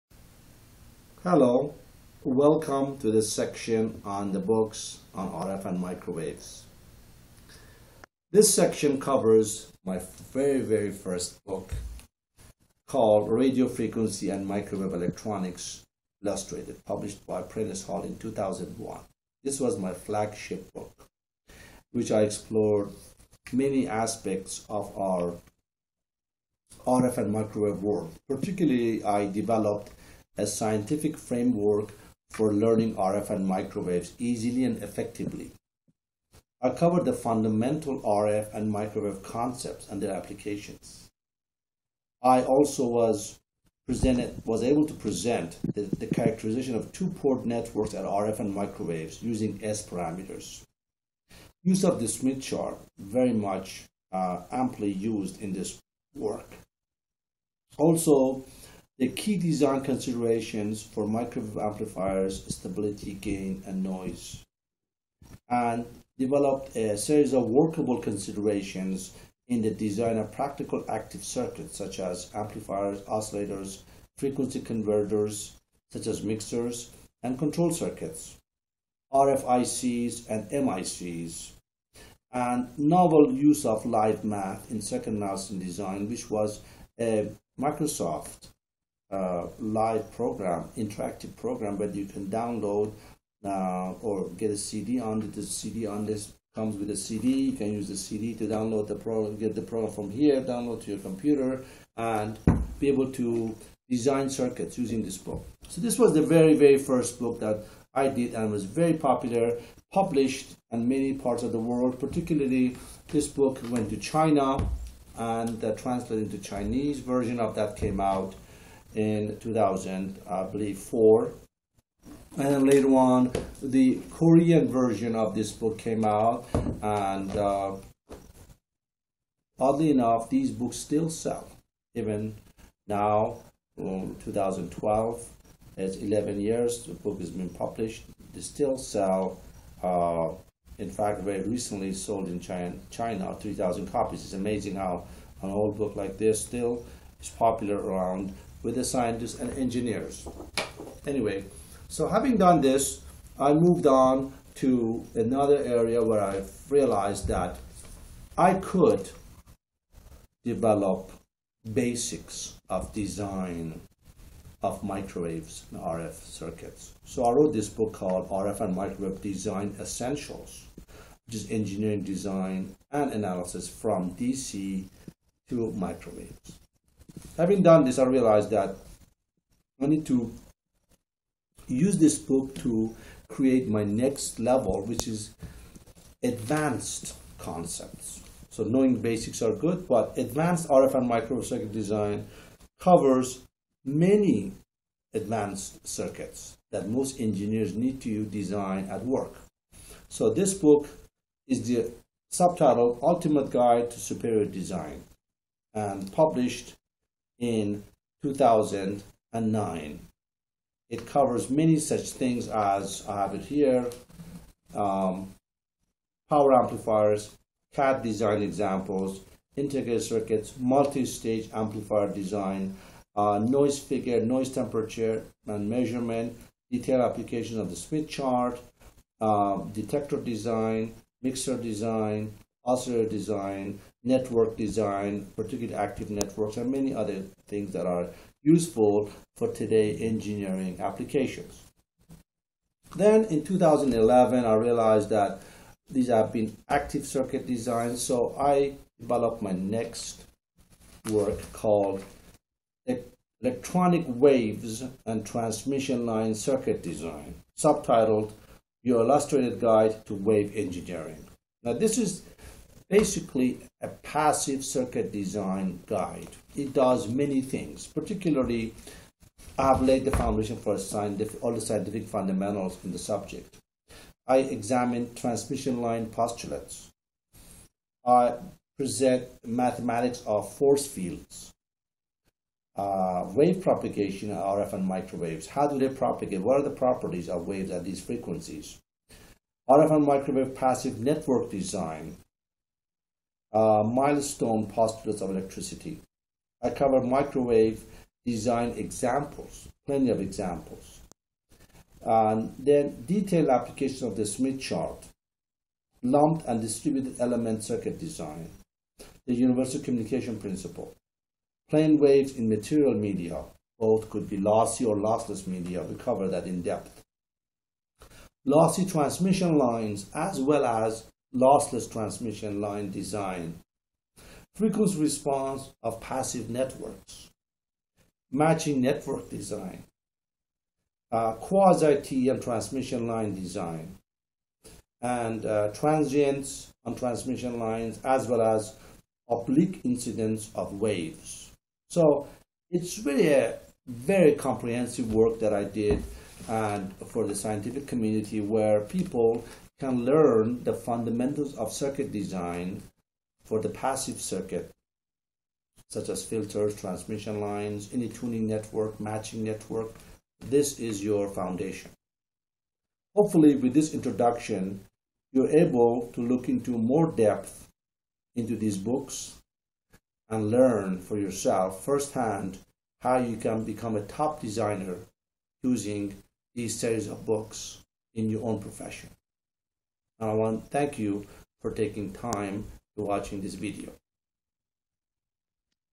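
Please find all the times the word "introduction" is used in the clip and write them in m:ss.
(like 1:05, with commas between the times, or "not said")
6:03.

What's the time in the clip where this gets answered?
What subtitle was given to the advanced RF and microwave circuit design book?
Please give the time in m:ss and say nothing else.
3:23.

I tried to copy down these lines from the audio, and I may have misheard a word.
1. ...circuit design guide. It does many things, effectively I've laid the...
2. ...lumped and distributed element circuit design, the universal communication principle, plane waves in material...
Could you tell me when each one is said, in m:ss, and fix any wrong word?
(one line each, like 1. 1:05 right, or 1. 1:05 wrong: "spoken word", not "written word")
1. 4:24 wrong: "particularly", not "effectively"
2. 5:06 right.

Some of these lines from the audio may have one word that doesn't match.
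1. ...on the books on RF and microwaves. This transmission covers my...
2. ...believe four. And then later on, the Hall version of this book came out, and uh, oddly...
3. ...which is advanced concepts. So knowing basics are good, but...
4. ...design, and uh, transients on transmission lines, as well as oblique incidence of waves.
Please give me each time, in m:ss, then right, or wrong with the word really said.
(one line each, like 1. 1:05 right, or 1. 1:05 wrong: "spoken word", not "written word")
1. 0:04 wrong: "section", not "transmission"
2. 2:00 wrong: "Korean", not "Hall"
3. 3:04 right
4. 5:33 right.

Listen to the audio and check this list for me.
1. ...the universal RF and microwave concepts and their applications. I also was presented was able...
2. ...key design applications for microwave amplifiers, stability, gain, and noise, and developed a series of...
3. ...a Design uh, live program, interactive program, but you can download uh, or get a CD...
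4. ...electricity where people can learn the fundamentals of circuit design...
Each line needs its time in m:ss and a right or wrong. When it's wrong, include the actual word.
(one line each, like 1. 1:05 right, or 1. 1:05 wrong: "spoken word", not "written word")
1. 0:37 wrong: "fundamental", not "universal"
2. 0:59 wrong: "considerations", not "applications"
3. 1:26 wrong: "Microsoft", not "Design"
4. 5:47 wrong: "community", not "electricity".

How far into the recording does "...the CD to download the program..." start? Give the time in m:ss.
1:37.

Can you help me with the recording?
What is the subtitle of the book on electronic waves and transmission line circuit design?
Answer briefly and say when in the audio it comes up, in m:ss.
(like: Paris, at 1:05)
Your Illustrated Guide to Wave Engineering, at 4:18.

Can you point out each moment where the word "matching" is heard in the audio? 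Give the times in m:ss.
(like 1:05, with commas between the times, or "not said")
5:28, 5:58.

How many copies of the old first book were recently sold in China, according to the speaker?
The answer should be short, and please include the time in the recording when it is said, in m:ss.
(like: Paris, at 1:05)
3,000, at 2:23.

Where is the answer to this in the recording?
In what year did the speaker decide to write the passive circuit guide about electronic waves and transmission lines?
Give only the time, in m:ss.
4:03.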